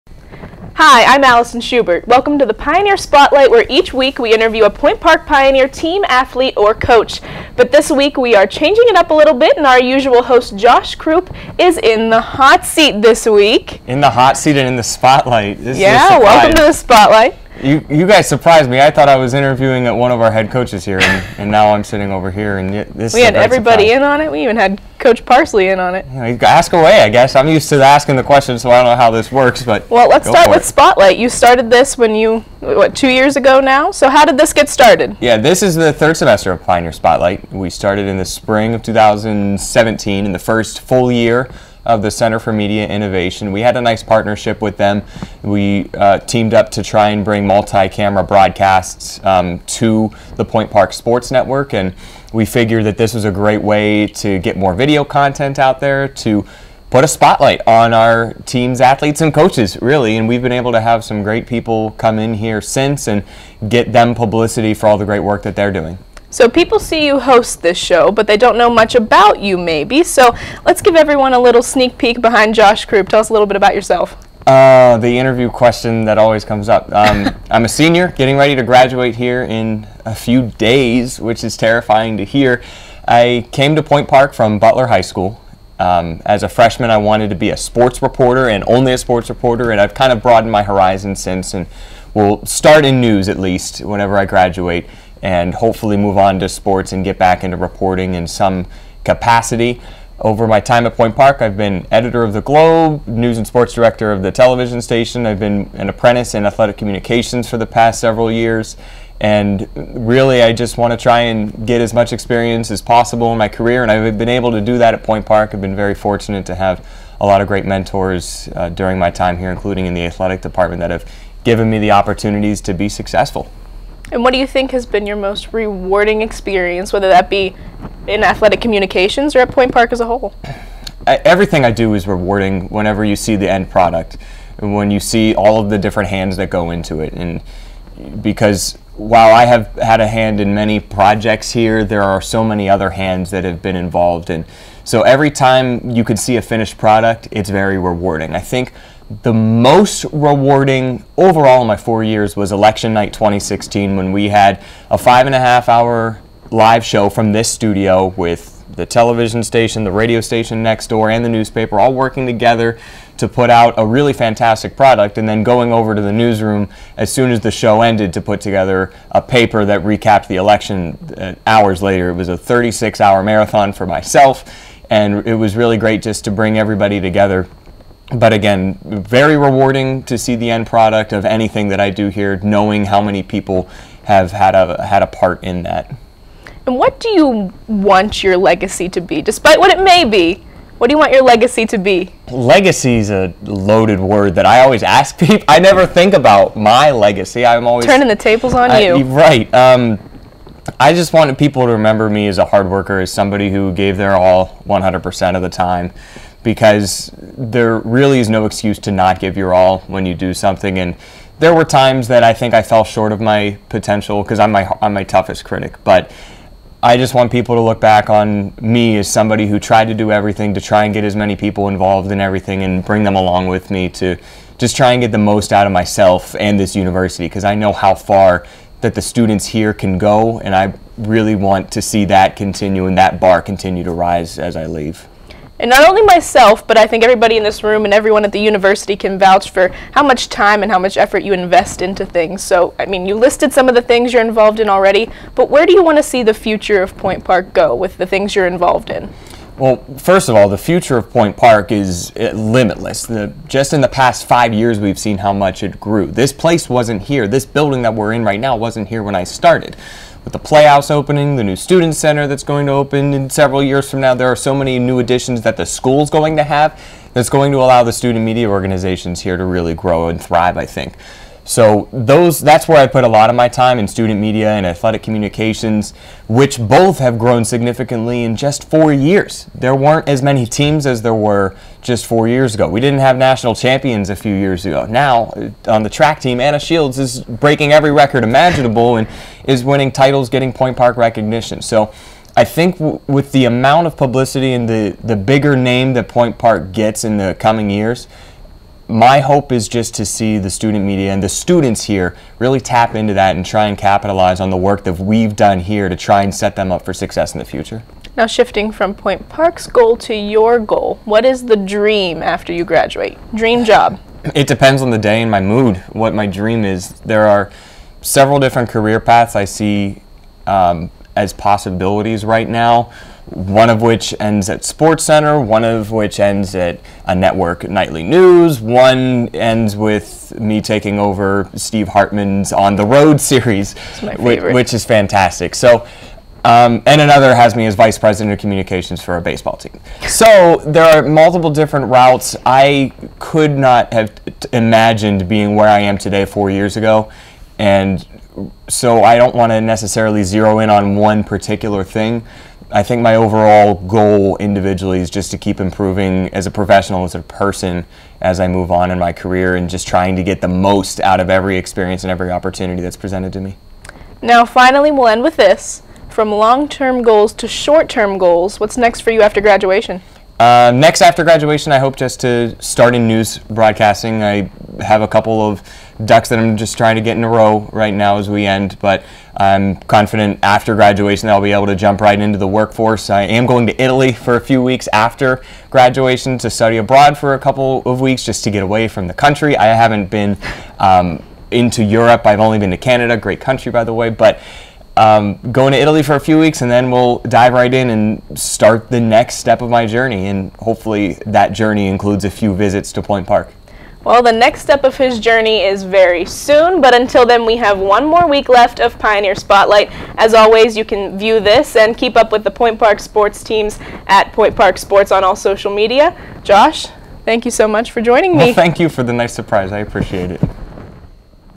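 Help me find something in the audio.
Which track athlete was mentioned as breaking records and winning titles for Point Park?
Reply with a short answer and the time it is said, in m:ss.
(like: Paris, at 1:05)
Anna Shields, at 4:46.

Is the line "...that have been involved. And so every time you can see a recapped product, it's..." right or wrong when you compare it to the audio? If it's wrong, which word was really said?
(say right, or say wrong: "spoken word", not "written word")
wrong: "finished", not "recapped".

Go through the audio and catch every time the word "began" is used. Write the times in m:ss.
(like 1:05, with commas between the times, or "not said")
not said.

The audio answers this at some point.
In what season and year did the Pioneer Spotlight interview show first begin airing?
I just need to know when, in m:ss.
0:38.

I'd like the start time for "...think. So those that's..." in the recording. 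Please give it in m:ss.
4:30.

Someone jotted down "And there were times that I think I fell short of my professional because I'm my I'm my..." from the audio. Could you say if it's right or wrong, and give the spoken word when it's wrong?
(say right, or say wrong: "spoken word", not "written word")
wrong: "potential", not "professional".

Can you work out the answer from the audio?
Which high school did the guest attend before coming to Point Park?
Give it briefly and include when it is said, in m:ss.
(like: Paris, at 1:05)
Butler High School, at 1:24.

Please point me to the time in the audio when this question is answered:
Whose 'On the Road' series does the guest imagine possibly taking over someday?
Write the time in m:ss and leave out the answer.
5:31.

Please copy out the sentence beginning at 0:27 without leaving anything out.
I'm used to asking the questions, so I don't know how this works.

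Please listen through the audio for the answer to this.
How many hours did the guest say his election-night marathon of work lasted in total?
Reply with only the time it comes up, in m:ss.
2:52.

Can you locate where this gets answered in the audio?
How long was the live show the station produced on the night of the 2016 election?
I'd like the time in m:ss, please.
2:34.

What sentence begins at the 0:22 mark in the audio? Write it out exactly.
And this we had everybody surprise.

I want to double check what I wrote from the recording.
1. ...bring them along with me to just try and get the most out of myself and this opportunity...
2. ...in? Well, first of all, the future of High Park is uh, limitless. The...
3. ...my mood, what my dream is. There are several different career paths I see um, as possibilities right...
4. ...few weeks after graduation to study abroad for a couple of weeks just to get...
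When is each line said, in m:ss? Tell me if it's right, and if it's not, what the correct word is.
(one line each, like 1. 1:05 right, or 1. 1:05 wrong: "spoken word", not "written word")
1. 3:42 wrong: "university", not "opportunity"
2. 4:08 wrong: "Point", not "High"
3. 5:15 right
4. 6:24 right.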